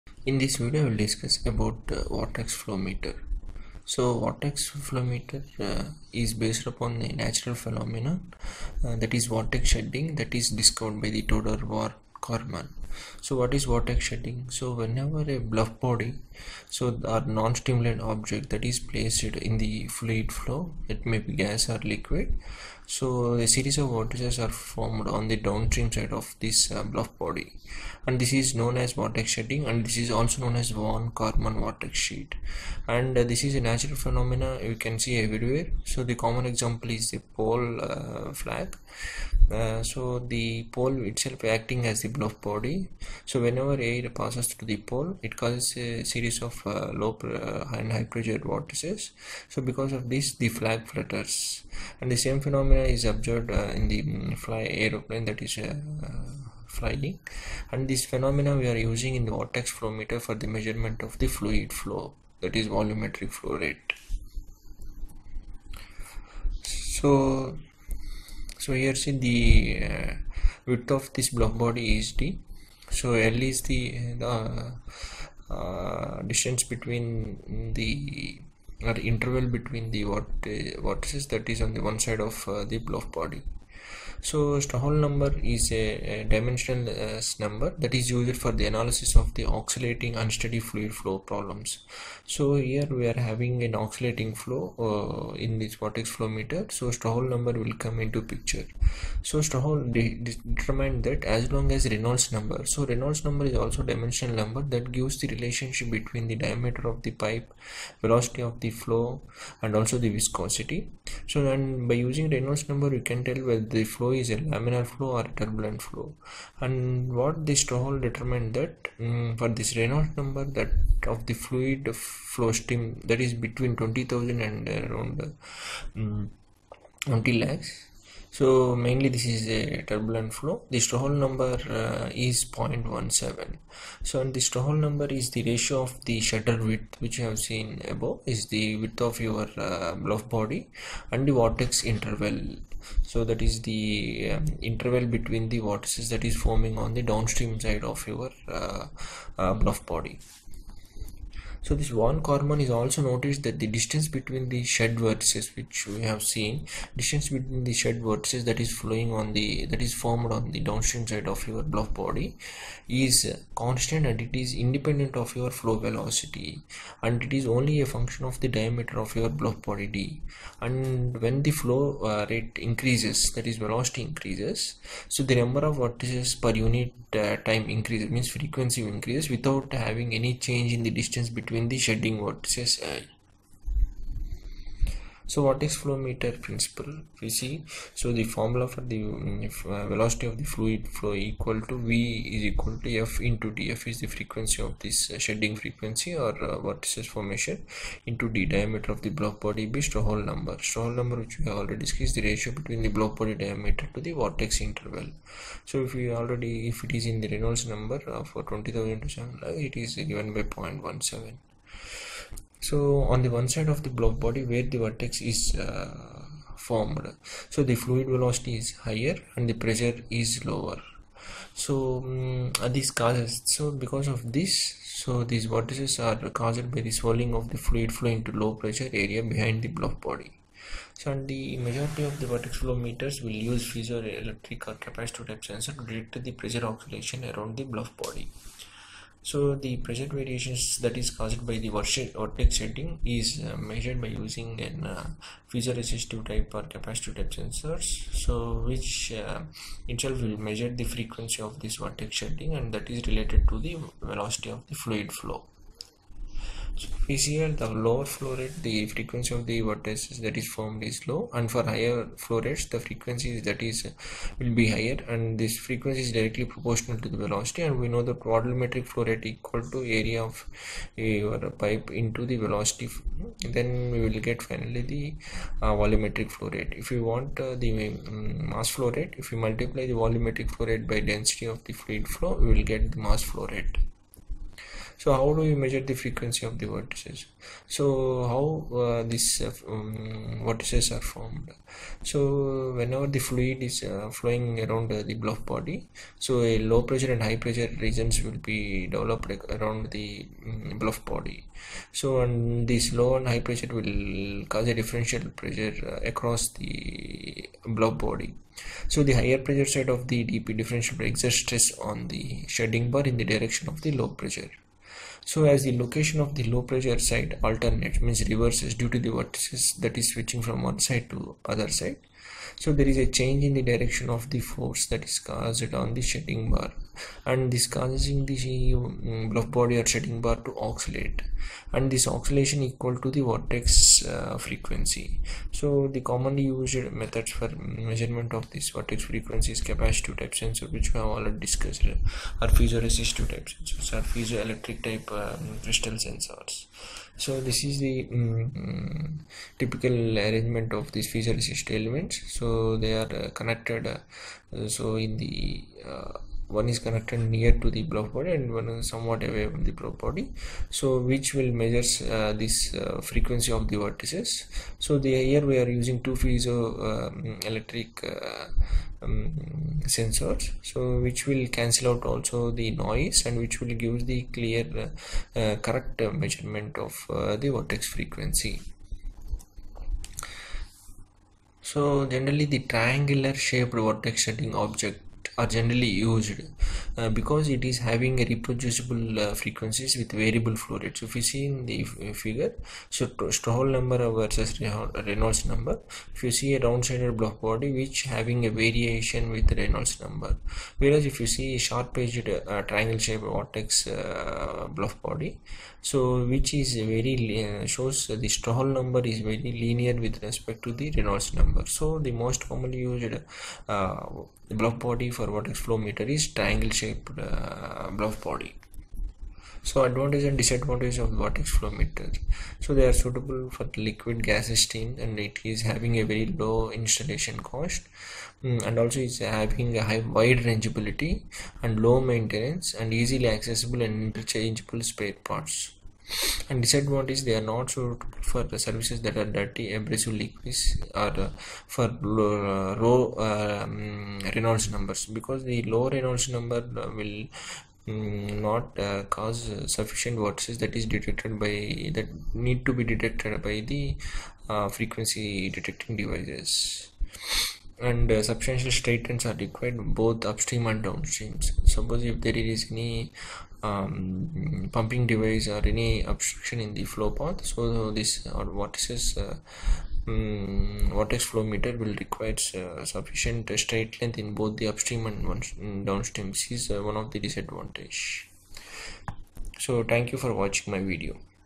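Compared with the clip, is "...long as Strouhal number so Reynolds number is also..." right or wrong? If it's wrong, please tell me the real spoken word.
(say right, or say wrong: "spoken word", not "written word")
wrong: "Reynolds", not "Strouhal".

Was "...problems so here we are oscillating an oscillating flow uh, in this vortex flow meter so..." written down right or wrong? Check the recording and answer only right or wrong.
wrong.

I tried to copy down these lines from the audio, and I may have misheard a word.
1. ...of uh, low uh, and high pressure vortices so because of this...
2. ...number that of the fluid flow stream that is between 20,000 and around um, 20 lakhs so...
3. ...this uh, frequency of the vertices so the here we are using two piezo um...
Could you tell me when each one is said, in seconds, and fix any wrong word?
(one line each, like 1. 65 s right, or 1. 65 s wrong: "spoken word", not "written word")
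1. 46 s right
2. 120 s right
3. 362 s right.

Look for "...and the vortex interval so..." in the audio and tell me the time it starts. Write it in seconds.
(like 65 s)
141 s.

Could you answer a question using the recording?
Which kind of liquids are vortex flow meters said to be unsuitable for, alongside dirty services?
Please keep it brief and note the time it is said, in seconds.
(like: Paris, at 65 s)
Abrasive liquids, at 439 s.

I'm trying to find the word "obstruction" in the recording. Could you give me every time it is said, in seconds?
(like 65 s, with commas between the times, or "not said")
466 s.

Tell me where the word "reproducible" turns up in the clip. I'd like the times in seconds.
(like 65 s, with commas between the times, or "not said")
388 s.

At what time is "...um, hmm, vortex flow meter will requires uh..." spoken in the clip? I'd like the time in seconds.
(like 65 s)
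470 s.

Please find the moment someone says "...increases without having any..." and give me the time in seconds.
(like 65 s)
178 s.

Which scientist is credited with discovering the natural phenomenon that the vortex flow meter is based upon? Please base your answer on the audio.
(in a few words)
Theodore von Karman.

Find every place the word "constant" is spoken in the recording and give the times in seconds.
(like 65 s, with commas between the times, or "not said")
163 s.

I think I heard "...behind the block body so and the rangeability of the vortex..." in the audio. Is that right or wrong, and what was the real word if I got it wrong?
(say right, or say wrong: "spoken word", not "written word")
wrong: "majority", not "rangeability".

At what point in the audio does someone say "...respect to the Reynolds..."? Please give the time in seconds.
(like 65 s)
410 s.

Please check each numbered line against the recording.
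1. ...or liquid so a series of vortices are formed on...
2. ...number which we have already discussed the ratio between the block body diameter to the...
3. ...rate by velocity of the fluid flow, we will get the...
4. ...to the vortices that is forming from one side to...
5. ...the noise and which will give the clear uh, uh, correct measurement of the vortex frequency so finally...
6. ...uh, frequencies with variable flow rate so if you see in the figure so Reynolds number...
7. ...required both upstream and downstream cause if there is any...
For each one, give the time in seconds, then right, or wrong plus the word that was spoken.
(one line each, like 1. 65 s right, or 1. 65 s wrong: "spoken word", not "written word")
1. 21 s right
2. 200 s right
3. 280 s wrong: "density", not "velocity"
4. 318 s wrong: "switching", not "forming"
5. 372 s wrong: "generally", not "finally"
6. 389 s wrong: "Strouhal", not "Reynolds"
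7. 459 s wrong: "suppose", not "cause".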